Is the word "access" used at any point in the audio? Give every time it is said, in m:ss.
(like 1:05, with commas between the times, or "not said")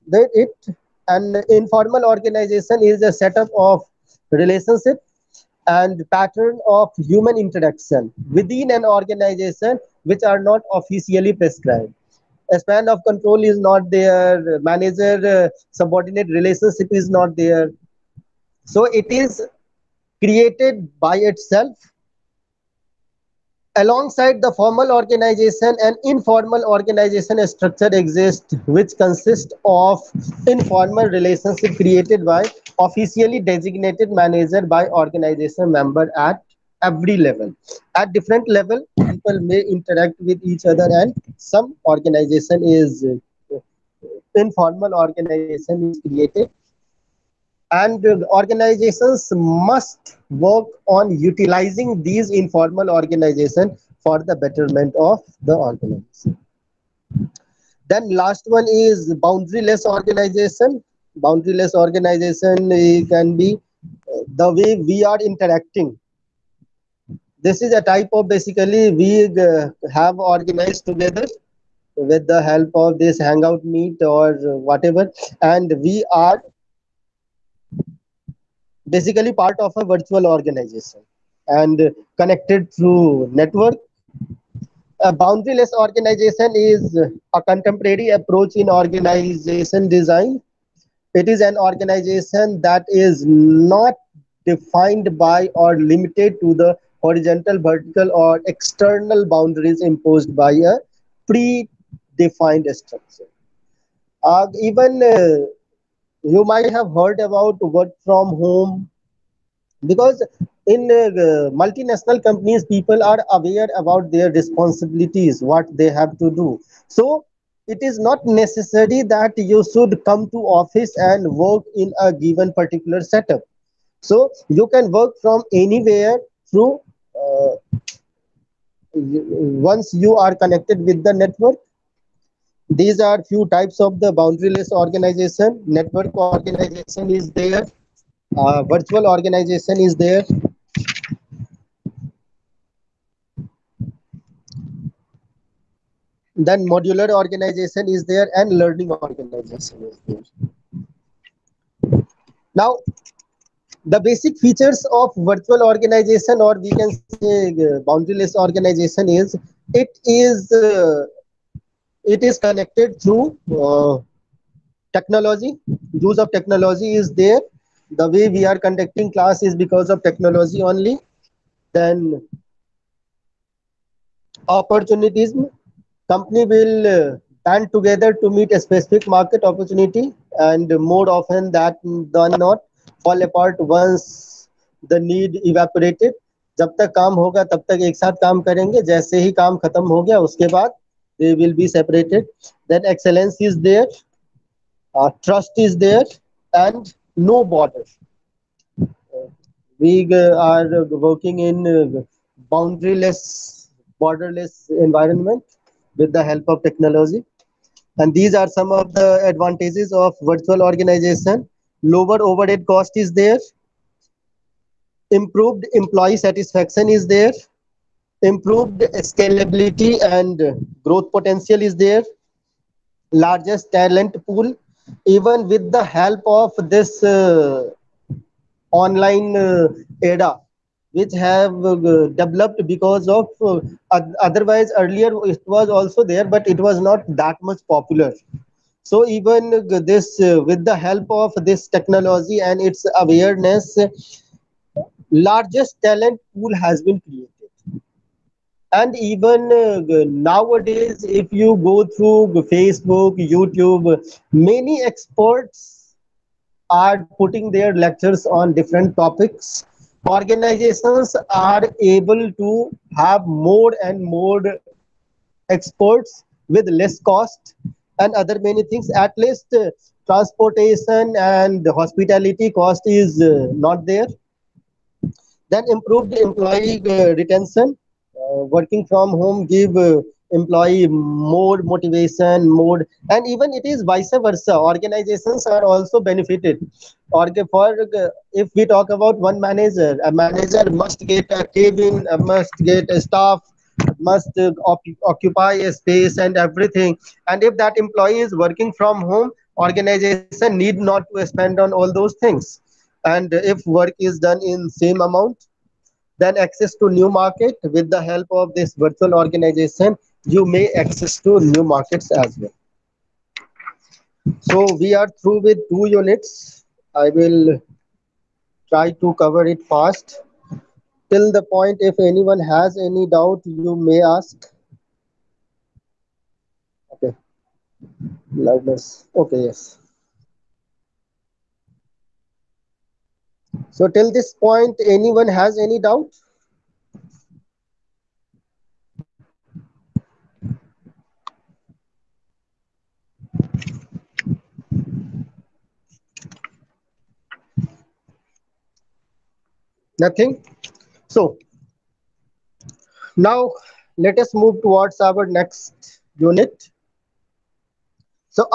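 5:06, 5:10.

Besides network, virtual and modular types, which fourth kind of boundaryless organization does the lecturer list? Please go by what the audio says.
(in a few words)
learning organization.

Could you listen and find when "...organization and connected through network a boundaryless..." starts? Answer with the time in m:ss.
1:20.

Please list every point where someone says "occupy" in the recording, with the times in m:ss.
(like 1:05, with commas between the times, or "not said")
4:55.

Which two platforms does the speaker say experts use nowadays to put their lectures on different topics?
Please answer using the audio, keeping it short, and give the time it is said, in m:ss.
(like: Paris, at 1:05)
Facebook, YouTube, at 4:12.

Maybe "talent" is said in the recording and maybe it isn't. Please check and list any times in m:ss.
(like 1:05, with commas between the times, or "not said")
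3:43, 4:05.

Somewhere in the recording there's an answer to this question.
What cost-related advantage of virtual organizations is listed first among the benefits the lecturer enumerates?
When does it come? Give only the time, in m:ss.
3:31.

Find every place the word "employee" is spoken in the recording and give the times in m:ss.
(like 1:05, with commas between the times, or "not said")
3:35, 4:36, 4:40, 4:57.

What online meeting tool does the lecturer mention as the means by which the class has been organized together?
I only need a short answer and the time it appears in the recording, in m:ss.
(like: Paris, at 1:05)
Hangout Meet, at 1:13.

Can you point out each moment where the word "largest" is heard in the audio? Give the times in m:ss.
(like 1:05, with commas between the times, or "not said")
3:43, 4:05.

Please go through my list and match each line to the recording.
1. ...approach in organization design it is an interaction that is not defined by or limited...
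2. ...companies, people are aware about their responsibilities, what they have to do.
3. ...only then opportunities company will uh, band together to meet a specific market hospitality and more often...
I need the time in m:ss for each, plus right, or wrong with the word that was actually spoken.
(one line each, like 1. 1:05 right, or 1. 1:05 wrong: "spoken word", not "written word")
1. 1:28 wrong: "organization", not "interaction"
2. 1:52 right
3. 2:50 wrong: "opportunity", not "hospitality".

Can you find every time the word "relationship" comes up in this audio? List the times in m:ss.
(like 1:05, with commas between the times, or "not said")
0:04, 0:16, 0:31.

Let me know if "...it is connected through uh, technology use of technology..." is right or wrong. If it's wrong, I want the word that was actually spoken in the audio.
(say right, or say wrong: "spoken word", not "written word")
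right.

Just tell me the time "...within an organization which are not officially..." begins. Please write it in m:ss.
0:08.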